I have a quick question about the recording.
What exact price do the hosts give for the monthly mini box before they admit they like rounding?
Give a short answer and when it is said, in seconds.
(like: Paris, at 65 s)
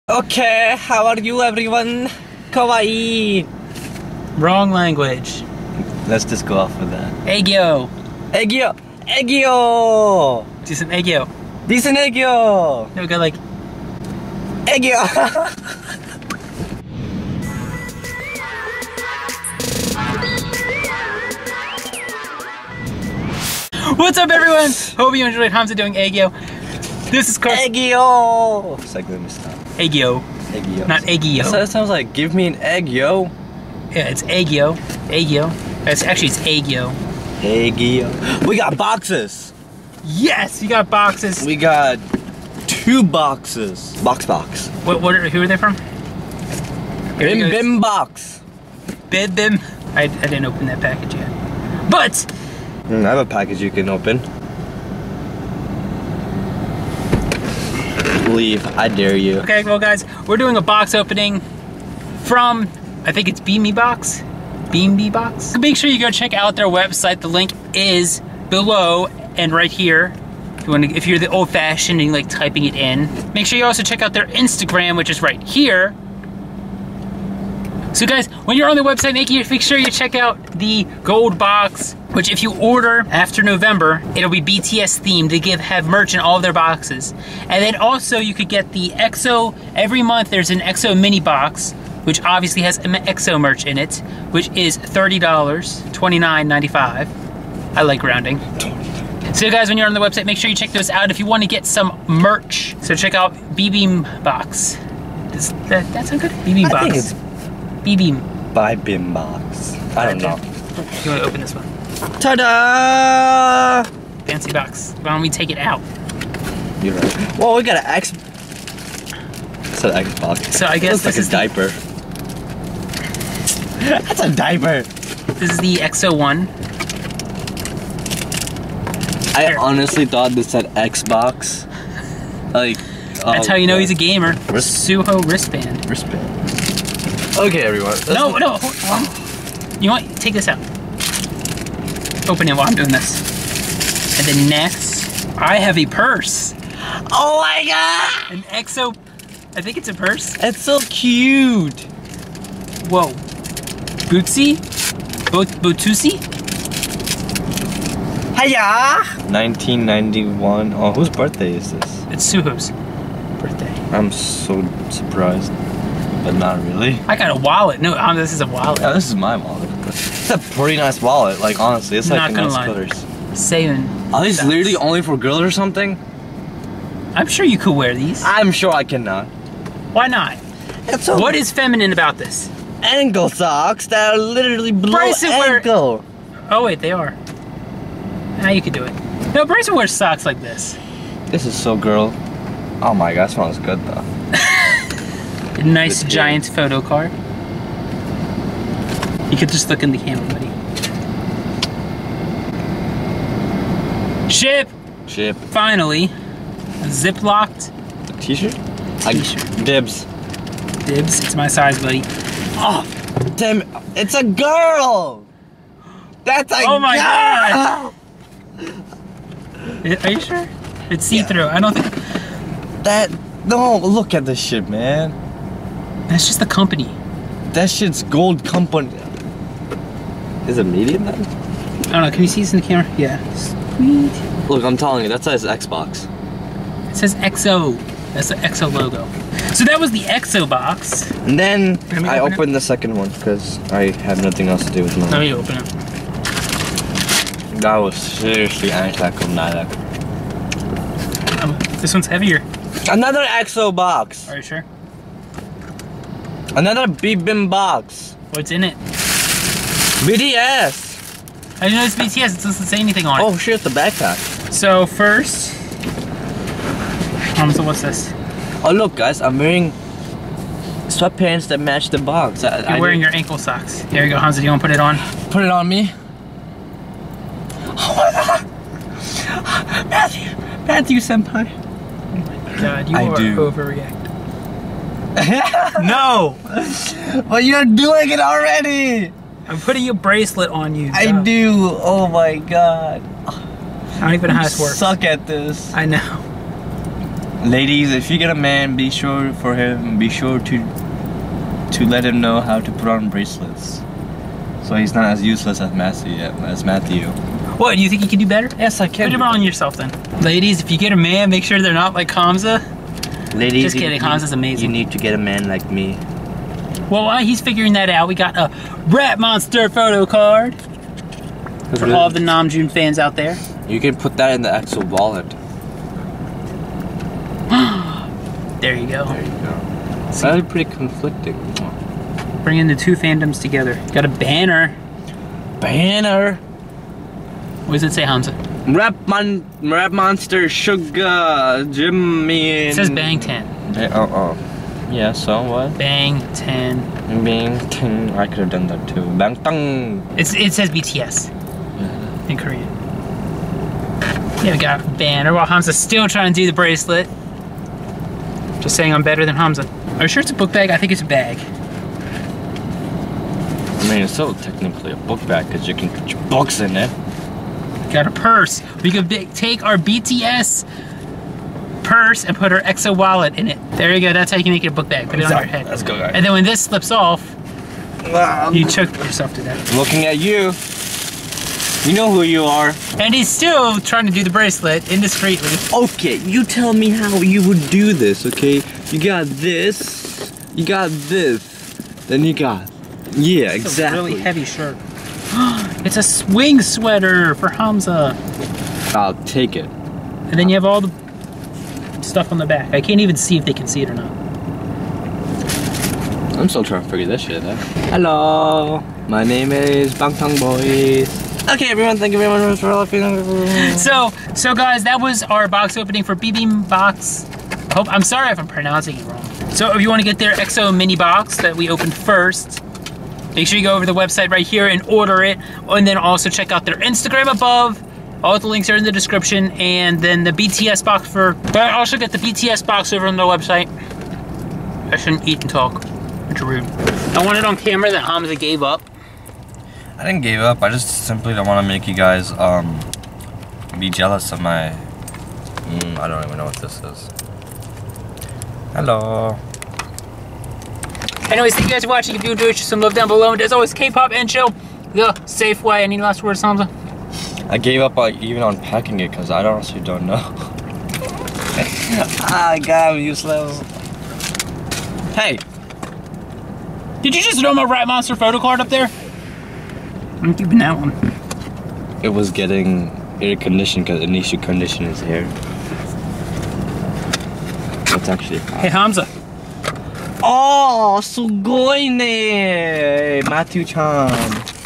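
$29.95, at 95 s.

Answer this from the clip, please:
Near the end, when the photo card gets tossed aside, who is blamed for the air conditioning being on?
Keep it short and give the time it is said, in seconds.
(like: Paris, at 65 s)
Anisha, at 474 s.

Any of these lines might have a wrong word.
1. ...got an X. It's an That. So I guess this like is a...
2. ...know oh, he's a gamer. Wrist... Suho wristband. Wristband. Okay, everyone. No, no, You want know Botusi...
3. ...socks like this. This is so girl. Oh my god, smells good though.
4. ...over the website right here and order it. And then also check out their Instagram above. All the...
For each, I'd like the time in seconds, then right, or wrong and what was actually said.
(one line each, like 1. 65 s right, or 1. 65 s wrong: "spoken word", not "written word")
1. 117 s wrong: "Xbox", not "That"
2. 133 s wrong: "Take", not "Botusi"
3. 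189 s right
4. 423 s right.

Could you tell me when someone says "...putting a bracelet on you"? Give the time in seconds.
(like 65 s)
289 s.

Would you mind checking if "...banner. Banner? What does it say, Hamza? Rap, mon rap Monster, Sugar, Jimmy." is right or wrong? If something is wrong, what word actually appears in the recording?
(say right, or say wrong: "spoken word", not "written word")
right.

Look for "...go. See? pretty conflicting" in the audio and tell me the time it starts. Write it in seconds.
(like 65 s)
329 s.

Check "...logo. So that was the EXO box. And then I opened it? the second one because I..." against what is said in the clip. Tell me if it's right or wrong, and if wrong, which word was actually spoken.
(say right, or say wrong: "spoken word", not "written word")
right.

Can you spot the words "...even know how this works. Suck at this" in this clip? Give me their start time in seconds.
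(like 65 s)
294 s.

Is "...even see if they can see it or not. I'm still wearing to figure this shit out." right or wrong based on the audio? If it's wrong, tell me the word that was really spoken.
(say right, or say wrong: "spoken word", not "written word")
wrong: "trying", not "wearing".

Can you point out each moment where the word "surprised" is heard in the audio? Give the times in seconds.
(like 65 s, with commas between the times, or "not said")
164 s.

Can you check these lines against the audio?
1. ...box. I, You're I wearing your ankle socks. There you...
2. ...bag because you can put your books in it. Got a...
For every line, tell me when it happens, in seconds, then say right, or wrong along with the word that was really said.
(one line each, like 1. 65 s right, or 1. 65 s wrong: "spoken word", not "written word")
1. 271 s right
2. 365 s right.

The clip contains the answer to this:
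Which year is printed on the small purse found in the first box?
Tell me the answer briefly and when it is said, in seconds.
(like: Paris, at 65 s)
1991, at 159 s.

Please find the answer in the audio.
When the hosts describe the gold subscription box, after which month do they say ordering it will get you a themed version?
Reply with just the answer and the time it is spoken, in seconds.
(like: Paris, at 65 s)
November, at 83 s.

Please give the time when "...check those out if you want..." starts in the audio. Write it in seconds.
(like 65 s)
100 s.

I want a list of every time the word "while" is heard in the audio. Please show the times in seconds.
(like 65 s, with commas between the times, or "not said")
142 s, 317 s, 355 s.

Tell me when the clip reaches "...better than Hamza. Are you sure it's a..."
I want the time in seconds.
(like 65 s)
359 s.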